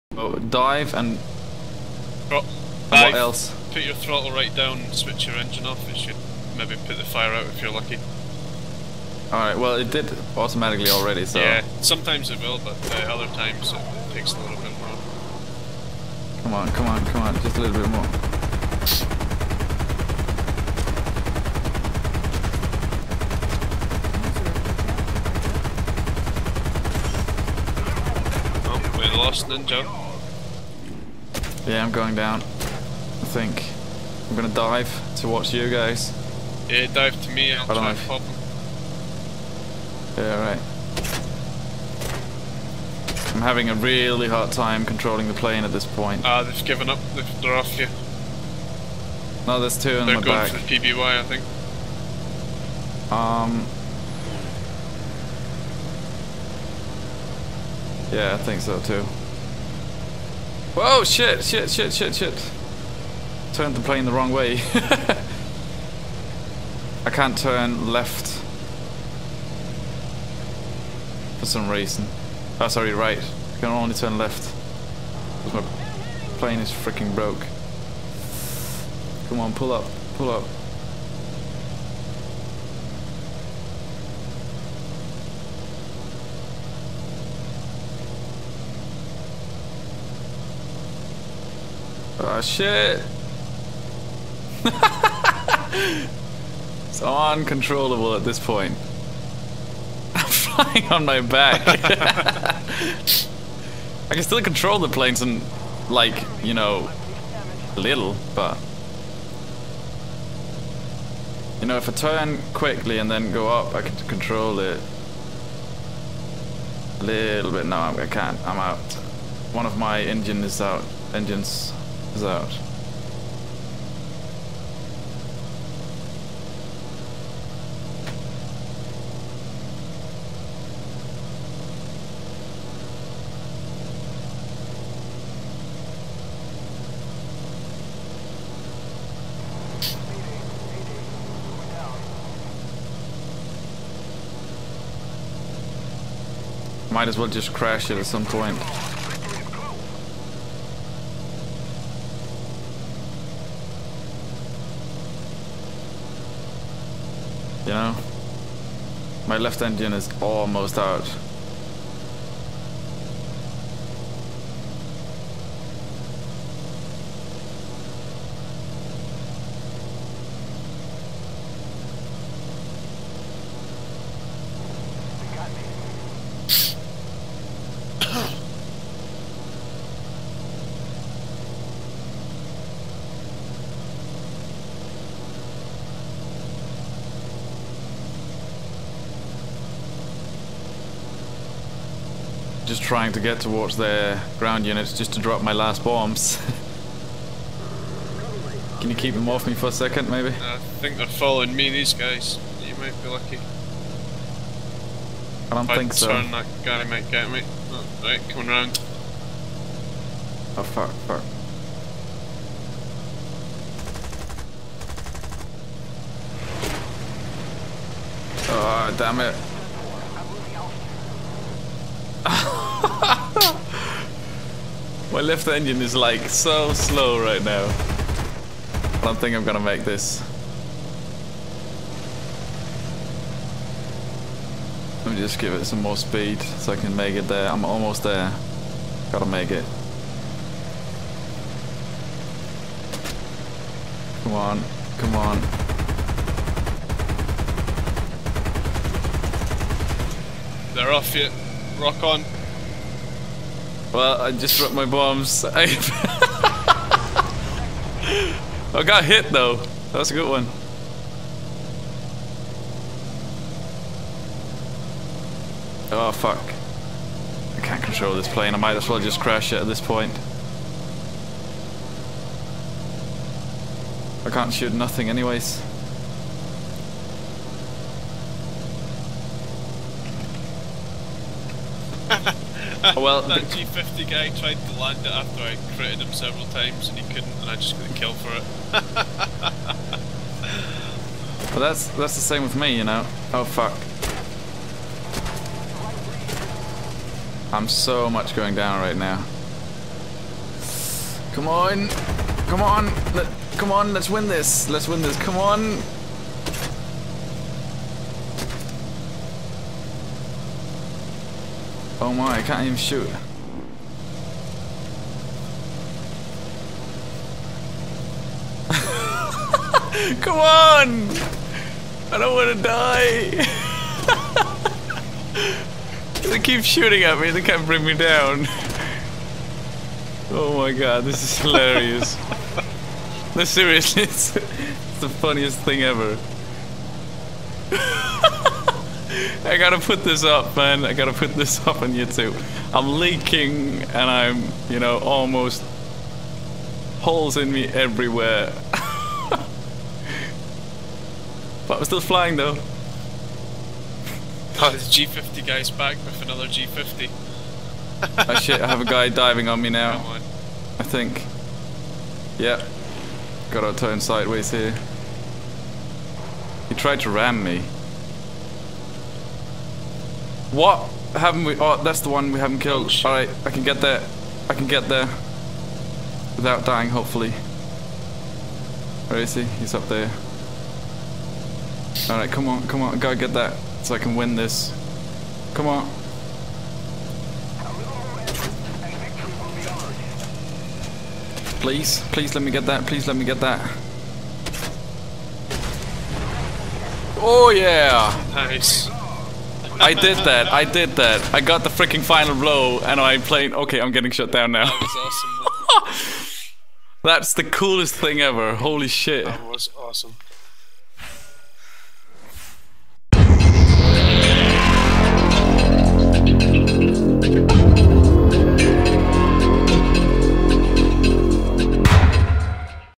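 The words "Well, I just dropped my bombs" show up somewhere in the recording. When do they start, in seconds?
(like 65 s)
253 s.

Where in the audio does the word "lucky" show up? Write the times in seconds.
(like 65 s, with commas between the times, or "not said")
7 s, 203 s.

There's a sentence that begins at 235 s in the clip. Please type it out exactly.
Let me just give it some more speed so I can make it there.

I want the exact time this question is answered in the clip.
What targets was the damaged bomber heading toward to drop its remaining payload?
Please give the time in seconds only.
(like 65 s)
194 s.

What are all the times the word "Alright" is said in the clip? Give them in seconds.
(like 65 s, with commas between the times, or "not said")
9 s.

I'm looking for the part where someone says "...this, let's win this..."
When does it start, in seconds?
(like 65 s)
304 s.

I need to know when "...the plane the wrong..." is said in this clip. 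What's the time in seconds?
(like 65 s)
63 s.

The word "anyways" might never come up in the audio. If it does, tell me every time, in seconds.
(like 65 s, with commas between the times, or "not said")
275 s.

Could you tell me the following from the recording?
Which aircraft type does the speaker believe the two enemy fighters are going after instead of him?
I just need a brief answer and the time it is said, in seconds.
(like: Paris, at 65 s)
PBY, at 50 s.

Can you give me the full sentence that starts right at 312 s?
Oh my, I can't even shoot.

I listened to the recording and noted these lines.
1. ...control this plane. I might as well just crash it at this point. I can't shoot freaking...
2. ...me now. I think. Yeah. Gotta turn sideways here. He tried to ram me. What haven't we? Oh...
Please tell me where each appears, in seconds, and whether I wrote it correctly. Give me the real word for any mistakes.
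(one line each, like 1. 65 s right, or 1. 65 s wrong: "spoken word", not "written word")
1. 267 s wrong: "nothing", not "freaking"
2. 359 s right.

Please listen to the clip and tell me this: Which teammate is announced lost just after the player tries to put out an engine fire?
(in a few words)
Ninja.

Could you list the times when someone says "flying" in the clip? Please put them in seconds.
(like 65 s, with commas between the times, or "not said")
100 s, 352 s.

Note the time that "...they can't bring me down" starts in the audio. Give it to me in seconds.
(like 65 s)
327 s.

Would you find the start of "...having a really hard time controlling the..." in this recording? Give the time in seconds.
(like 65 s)
43 s.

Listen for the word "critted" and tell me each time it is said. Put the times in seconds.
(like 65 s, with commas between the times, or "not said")
285 s.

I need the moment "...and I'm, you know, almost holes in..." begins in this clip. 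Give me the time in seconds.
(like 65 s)
343 s.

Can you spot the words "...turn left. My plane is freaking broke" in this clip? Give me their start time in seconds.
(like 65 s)
73 s.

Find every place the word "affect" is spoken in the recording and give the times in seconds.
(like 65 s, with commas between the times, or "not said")
not said.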